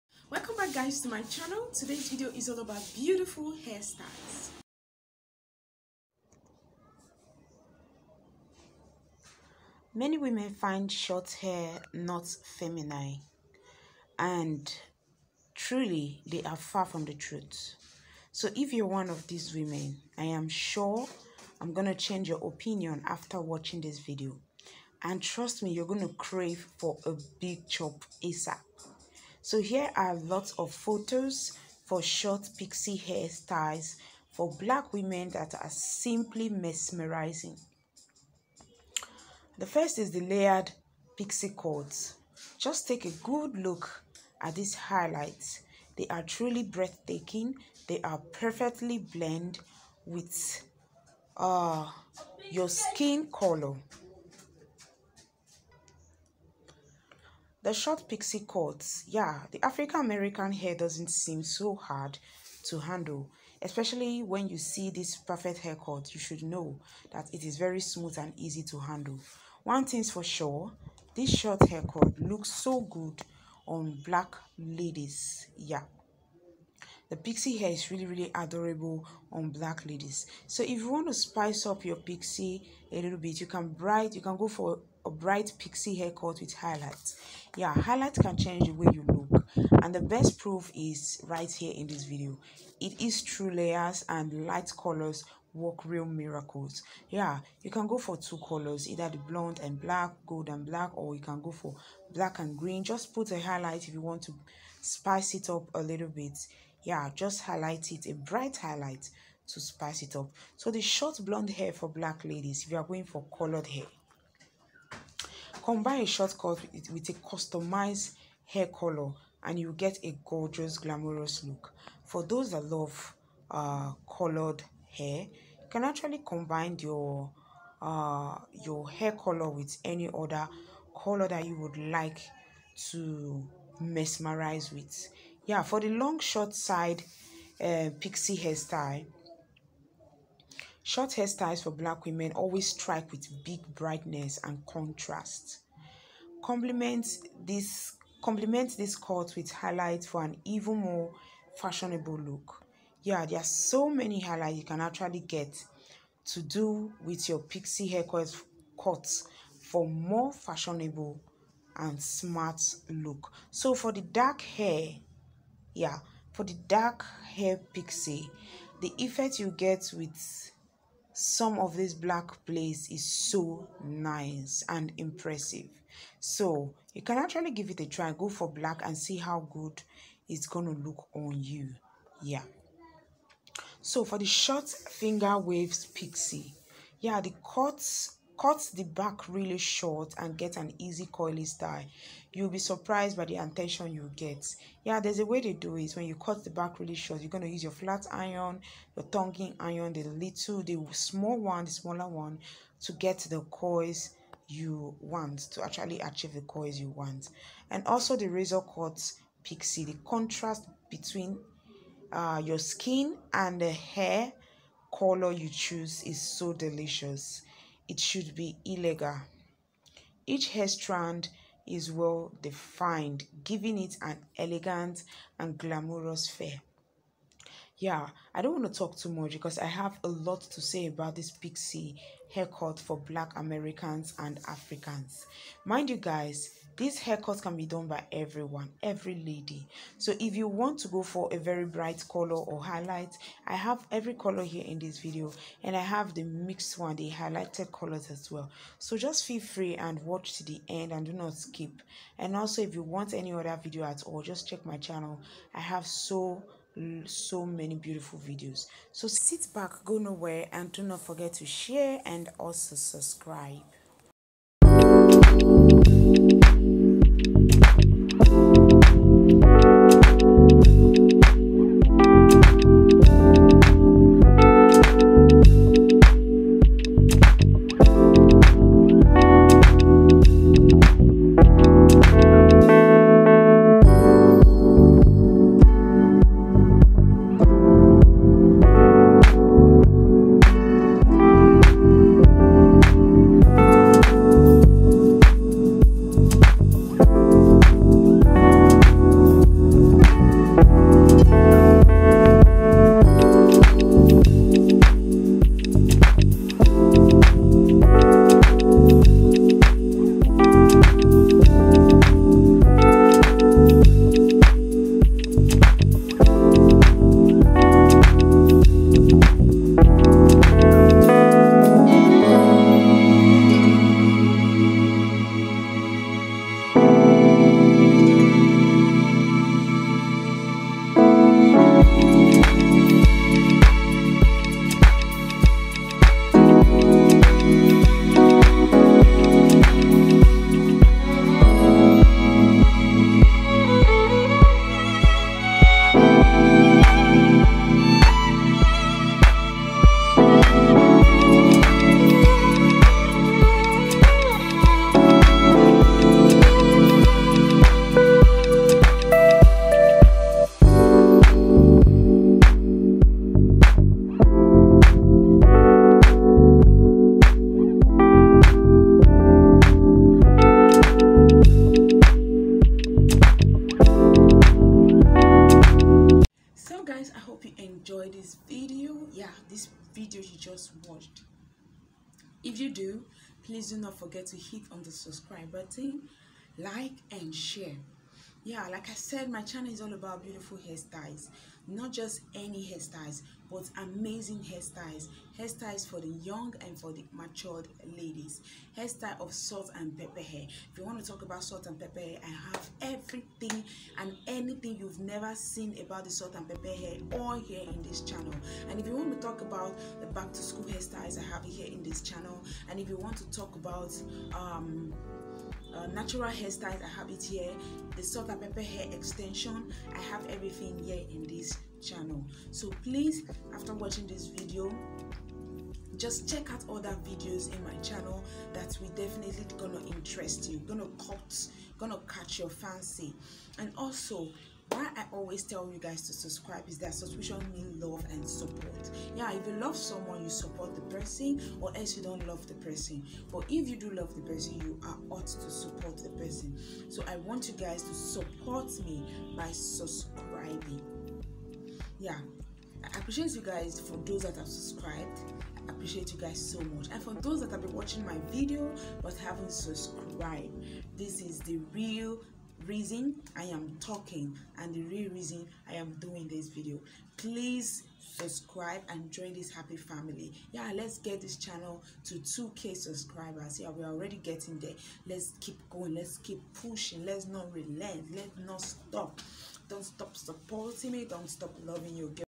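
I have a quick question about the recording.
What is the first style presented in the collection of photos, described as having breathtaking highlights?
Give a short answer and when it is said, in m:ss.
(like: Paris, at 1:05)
Layered pixie, at 0:40.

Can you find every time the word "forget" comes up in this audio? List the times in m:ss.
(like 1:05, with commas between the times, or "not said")
4:21, 6:23.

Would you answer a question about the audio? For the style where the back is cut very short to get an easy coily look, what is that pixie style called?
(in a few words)
Short finger waves pixie.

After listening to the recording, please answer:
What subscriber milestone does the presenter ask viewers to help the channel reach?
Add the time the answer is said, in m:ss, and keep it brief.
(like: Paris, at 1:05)
2k, at 7:52.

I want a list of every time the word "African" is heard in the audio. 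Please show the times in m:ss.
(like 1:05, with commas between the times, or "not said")
0:59, 3:54.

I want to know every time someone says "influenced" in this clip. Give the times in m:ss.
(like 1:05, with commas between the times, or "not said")
not said.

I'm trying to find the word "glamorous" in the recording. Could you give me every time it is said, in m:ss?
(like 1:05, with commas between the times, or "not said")
2:00, 3:45.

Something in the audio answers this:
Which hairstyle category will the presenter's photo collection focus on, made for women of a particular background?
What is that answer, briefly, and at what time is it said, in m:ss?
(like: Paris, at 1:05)
Short pixie hairstyles, at 0:32.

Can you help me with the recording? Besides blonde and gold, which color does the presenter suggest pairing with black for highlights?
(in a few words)
Green.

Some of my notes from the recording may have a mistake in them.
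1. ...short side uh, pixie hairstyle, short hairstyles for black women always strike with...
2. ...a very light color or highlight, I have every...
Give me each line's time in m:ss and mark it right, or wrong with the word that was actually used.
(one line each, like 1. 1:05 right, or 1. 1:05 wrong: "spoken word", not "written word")
1. 2:16 right
2. 4:01 wrong: "bright", not "light".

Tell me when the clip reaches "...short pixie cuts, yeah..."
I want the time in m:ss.
0:57.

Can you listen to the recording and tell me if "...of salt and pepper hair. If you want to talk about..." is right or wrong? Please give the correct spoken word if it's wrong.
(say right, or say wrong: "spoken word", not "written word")
right.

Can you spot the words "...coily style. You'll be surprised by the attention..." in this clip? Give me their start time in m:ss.
3:11.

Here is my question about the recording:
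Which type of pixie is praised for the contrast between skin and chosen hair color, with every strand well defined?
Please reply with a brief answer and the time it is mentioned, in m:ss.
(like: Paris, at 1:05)
Razor cut pixie, at 3:28.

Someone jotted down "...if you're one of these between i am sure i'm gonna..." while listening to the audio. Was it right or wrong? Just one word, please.
wrong.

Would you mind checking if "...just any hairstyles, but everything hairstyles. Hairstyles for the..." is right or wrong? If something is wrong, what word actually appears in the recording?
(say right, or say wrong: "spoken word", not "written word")
wrong: "amazing", not "everything".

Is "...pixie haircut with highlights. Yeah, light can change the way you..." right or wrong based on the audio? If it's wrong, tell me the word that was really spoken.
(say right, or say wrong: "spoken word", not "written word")
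wrong: "highlight", not "light".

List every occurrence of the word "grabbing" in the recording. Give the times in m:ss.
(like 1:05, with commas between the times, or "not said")
not said.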